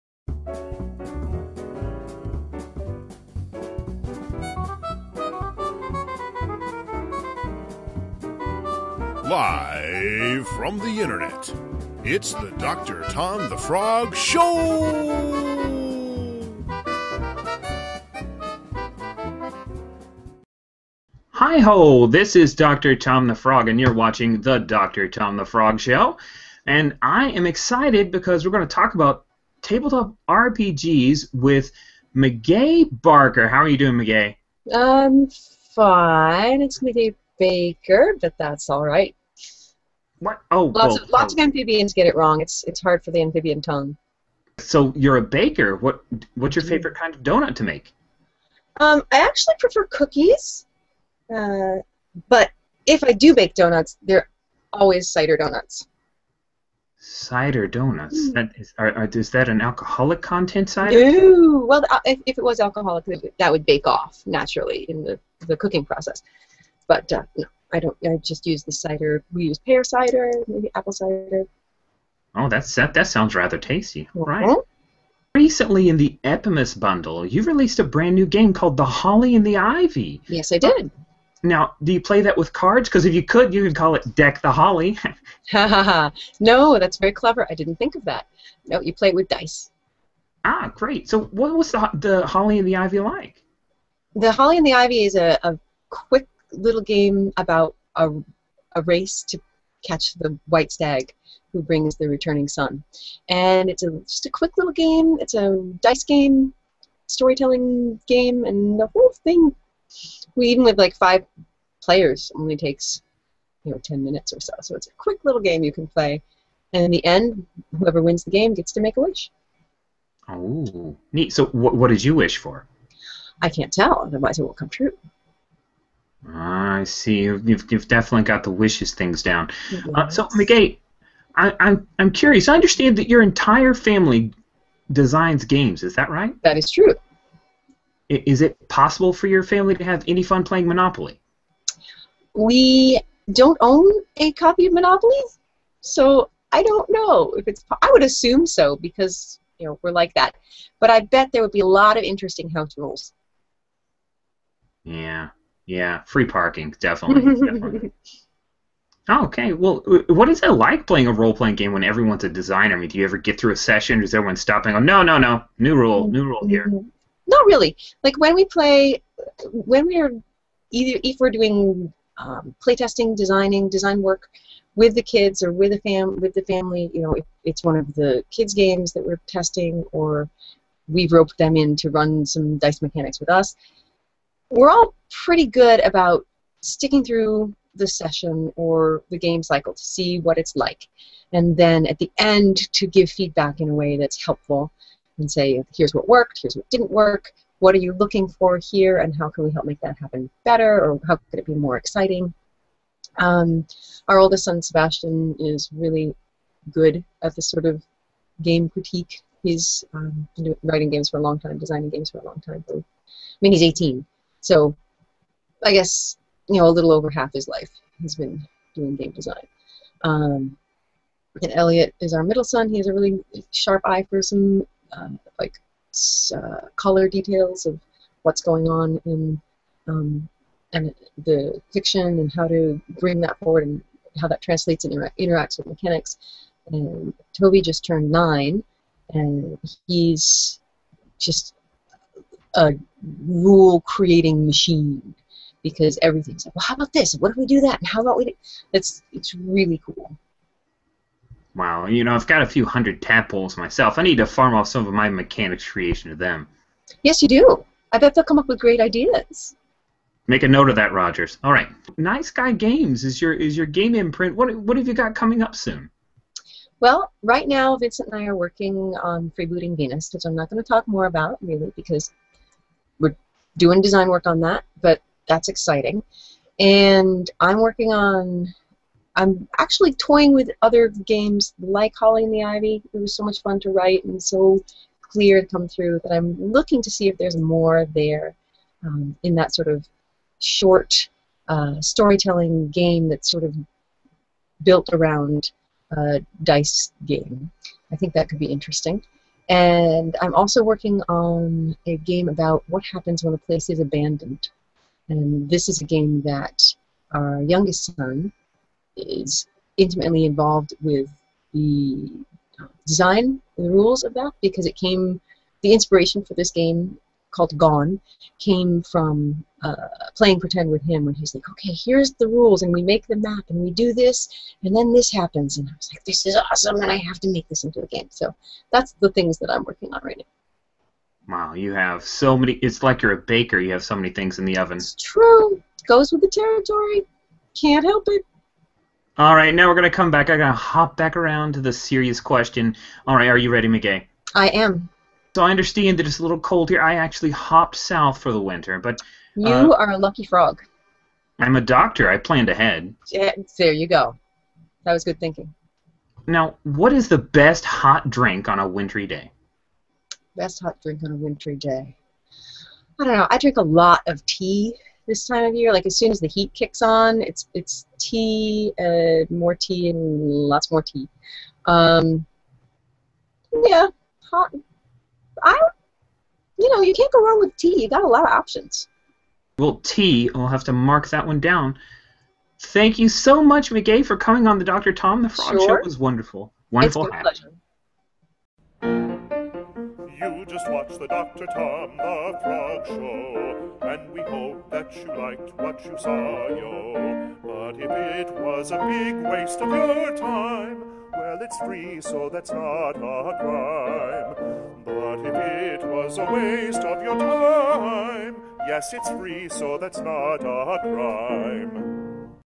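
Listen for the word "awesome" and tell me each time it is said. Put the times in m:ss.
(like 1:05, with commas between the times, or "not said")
5:26.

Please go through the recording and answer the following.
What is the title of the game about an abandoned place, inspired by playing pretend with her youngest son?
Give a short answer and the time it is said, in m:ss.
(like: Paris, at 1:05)
Gone, at 5:17.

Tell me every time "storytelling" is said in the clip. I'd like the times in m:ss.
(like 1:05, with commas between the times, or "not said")
1:47, 4:51.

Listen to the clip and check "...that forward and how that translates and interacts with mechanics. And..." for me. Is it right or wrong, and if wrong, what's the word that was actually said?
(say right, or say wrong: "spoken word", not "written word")
right.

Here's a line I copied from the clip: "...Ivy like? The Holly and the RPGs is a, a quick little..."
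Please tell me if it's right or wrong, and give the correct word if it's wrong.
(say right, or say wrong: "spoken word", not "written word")
wrong: "Ivy", not "RPGs".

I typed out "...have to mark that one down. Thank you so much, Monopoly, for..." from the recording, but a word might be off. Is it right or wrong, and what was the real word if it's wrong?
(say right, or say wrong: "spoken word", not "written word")
wrong: "Meguey", not "Monopoly".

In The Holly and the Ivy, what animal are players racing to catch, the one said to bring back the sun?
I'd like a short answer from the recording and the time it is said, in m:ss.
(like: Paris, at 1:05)
White stag, at 1:40.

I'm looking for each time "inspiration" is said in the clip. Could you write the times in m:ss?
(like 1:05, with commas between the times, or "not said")
5:15.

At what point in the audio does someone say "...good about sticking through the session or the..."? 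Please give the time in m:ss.
3:05.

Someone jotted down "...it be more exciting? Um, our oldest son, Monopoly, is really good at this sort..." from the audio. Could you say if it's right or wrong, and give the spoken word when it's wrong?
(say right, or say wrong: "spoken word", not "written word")
wrong: "Sebastian", not "Monopoly".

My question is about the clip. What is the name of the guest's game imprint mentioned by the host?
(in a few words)
Night Sky Games.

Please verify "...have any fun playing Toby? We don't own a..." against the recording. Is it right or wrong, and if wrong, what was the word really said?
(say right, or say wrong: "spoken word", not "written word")
wrong: "Monopoly", not "Toby".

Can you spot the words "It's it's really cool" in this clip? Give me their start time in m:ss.
4:08.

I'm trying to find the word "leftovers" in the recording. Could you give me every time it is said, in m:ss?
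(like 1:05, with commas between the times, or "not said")
not said.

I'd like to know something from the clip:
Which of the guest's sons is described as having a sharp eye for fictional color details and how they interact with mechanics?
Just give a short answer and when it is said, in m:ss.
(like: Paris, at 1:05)
Elliot, at 3:41.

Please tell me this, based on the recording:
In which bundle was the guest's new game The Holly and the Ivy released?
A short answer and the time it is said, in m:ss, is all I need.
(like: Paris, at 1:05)
Epimus bundle, at 1:16.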